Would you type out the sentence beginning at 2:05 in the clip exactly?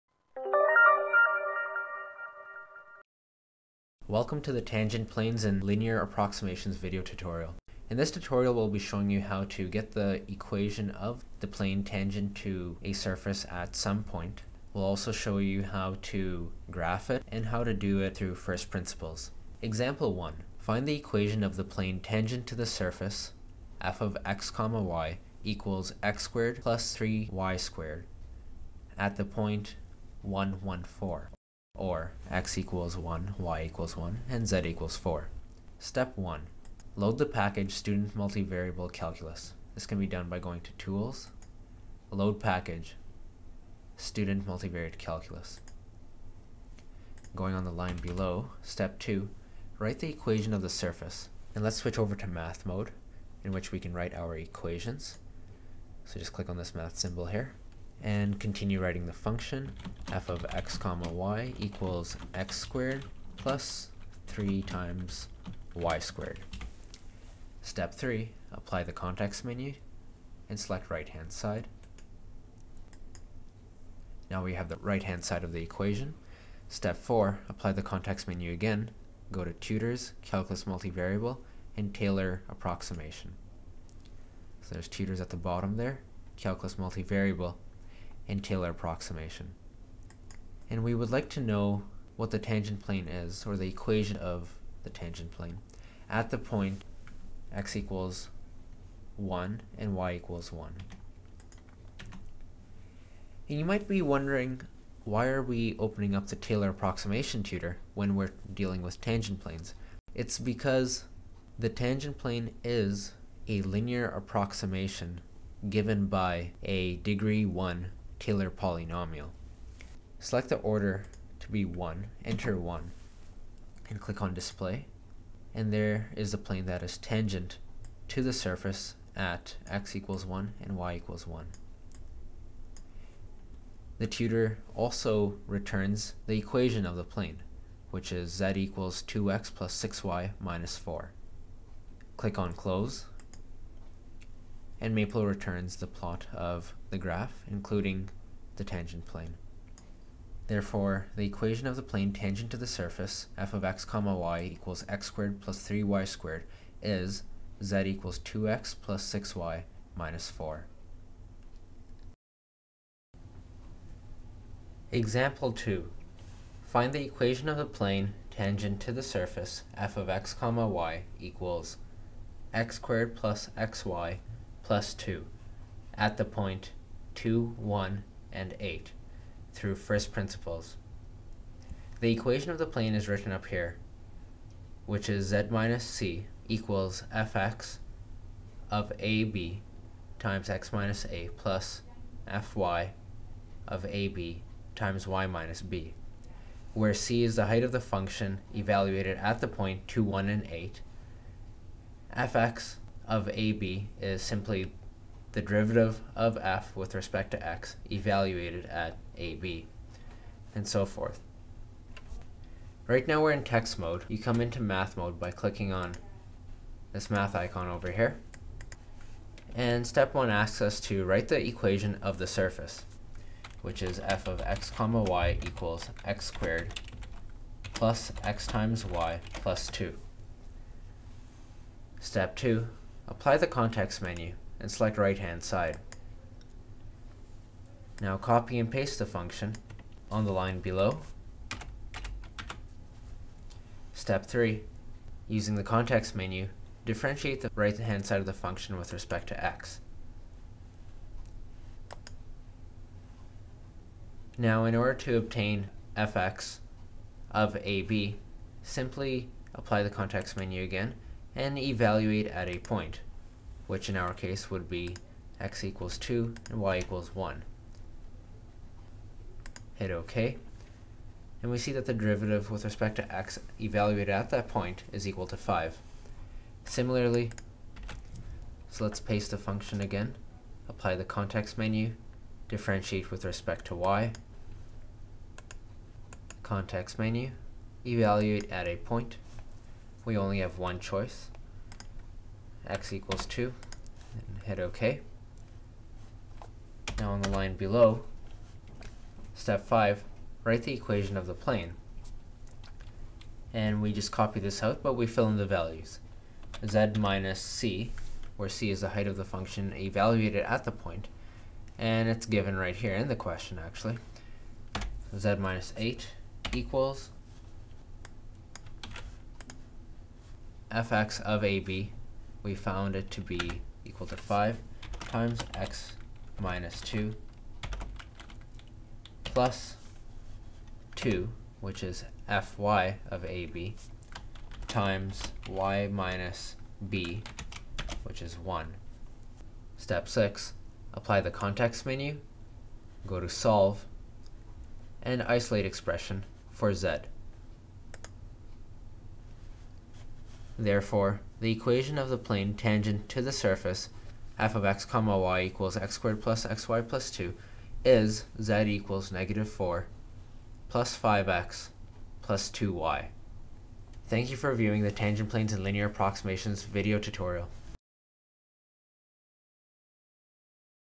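And there is the plane that is tangent to the surface at x equals 1 and y equals 1.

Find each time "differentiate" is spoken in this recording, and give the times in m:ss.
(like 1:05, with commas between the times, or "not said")
4:06, 4:42.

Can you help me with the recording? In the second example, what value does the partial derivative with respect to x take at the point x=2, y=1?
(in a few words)
5.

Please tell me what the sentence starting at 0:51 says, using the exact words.
And let's switch over to math mode, in which we can write our equations.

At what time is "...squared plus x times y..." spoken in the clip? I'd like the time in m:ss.
3:46.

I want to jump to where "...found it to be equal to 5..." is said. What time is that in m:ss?
5:22.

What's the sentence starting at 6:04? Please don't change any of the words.
Thank you for viewing the Tangent Planes and Linear Approximations video tutorial.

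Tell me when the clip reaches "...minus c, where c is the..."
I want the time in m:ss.
5:06.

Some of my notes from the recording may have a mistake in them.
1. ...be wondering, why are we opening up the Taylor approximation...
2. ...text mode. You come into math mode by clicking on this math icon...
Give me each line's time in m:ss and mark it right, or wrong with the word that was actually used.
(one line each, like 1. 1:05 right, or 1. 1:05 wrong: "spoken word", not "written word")
1. 1:43 right
2. 3:33 right.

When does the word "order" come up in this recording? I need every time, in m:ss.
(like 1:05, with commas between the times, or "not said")
2:00, 4:14.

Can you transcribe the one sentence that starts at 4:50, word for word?
We only have one choice, x equals 2, and hit OK.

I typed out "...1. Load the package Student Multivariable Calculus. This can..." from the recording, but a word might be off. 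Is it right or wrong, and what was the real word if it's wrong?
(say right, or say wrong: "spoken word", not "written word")
right.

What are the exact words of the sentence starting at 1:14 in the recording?
Now we have the right hand side of the equation.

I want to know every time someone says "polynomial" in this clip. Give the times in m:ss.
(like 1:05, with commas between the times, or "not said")
1:58.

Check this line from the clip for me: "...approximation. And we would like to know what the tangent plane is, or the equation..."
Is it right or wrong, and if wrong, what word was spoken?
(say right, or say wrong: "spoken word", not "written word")
right.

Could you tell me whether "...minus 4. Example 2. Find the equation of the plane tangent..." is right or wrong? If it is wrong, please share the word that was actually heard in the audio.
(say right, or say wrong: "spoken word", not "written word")
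right.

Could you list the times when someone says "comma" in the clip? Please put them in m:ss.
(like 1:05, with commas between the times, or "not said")
0:24, 1:00, 2:33, 2:50, 3:44, 5:54.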